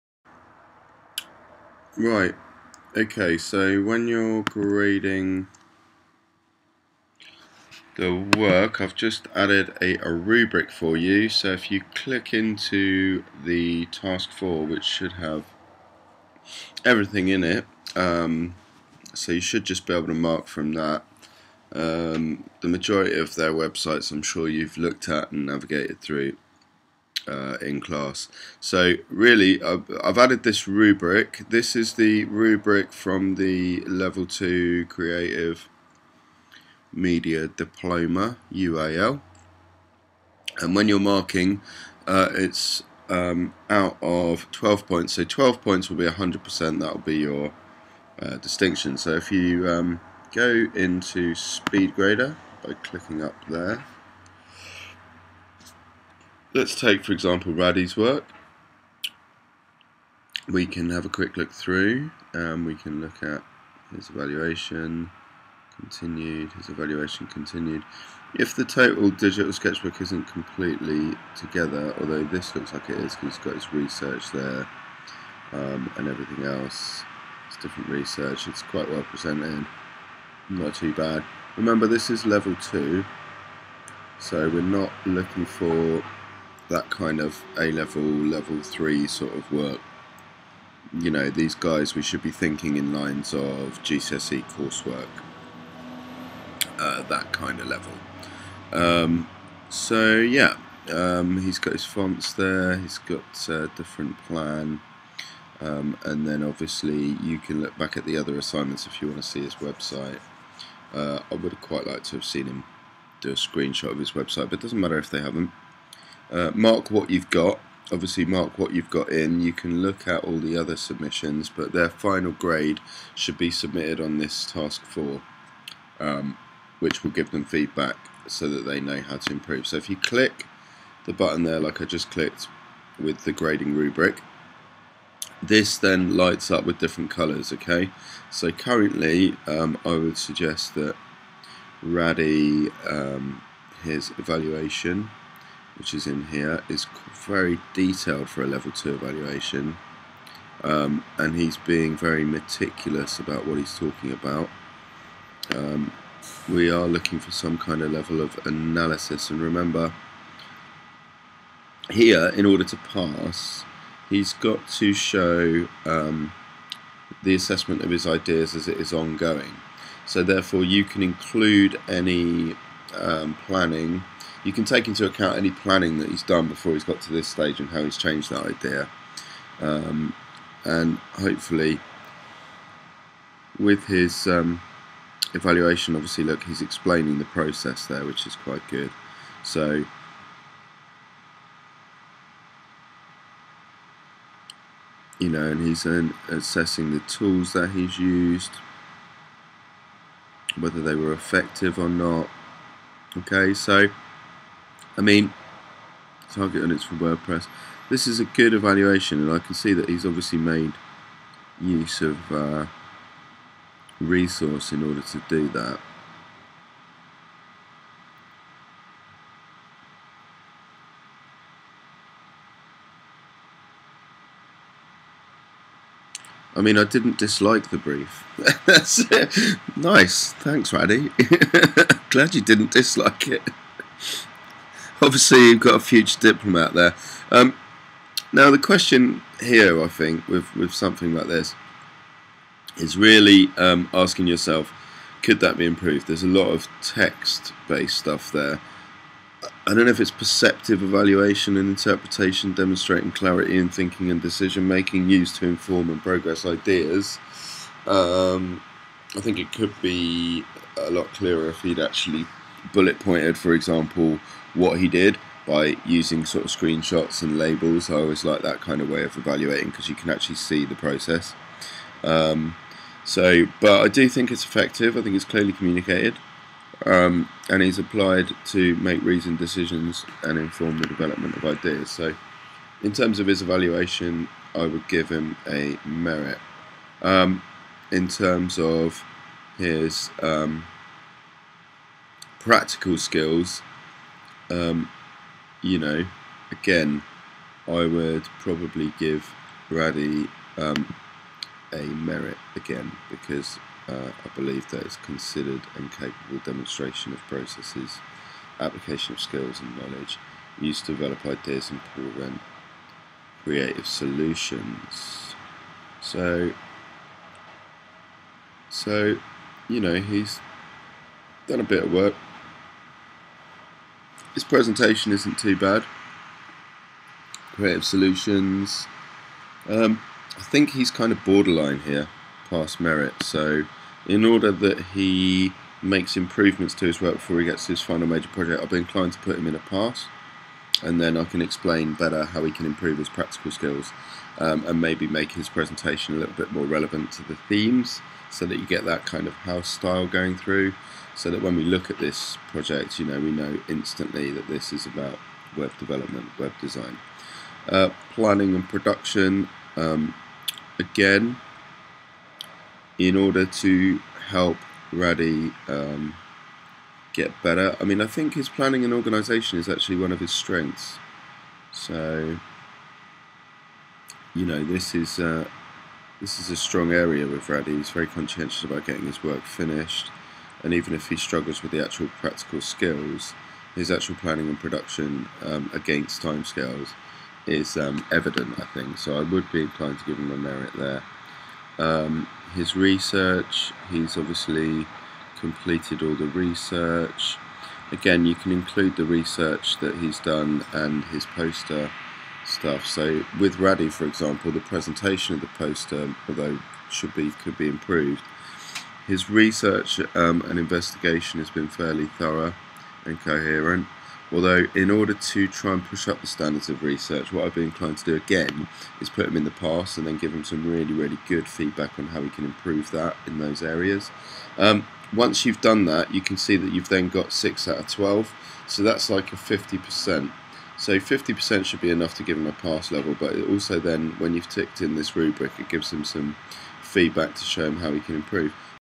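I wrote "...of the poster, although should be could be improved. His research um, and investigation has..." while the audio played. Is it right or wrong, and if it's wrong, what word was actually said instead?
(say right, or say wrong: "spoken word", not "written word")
right.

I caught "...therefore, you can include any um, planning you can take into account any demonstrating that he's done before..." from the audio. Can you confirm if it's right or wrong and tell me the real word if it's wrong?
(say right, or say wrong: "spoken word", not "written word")
wrong: "planning", not "demonstrating".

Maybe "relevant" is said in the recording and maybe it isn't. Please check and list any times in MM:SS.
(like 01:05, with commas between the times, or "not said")
05:46.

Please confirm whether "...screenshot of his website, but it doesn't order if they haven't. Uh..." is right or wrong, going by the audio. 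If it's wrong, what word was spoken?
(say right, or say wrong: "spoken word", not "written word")
wrong: "matter", not "order".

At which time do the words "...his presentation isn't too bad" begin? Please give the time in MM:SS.
05:24.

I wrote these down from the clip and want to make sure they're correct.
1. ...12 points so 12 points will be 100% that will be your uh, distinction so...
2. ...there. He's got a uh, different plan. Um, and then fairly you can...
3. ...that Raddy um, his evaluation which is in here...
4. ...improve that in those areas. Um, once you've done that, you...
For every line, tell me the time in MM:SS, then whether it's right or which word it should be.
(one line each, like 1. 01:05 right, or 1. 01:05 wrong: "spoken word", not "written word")
1. 00:44 right
2. 01:42 wrong: "obviously", not "fairly"
3. 02:20 right
4. 07:02 right.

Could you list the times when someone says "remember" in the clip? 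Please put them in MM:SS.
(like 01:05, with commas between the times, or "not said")
01:21, 02:39.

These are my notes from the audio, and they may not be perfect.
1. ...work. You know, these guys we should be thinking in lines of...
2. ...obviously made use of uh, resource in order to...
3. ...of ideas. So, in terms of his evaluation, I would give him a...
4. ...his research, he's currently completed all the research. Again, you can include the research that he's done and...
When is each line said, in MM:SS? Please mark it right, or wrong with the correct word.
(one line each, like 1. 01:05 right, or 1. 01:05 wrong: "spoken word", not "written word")
1. 01:29 right
2. 03:30 right
3. 04:41 right
4. 06:32 wrong: "obviously", not "currently".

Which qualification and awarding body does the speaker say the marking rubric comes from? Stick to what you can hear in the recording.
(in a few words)
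Level 2 Creative Media Diploma UAL.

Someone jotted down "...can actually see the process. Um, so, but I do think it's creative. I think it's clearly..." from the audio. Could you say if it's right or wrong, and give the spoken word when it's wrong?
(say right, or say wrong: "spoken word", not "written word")
wrong: "effective", not "creative".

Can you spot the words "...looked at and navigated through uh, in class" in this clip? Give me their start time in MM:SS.
00:24.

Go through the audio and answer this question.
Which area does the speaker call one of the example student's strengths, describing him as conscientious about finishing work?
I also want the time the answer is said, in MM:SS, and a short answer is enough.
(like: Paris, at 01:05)
Planning and organisation, at 06:08.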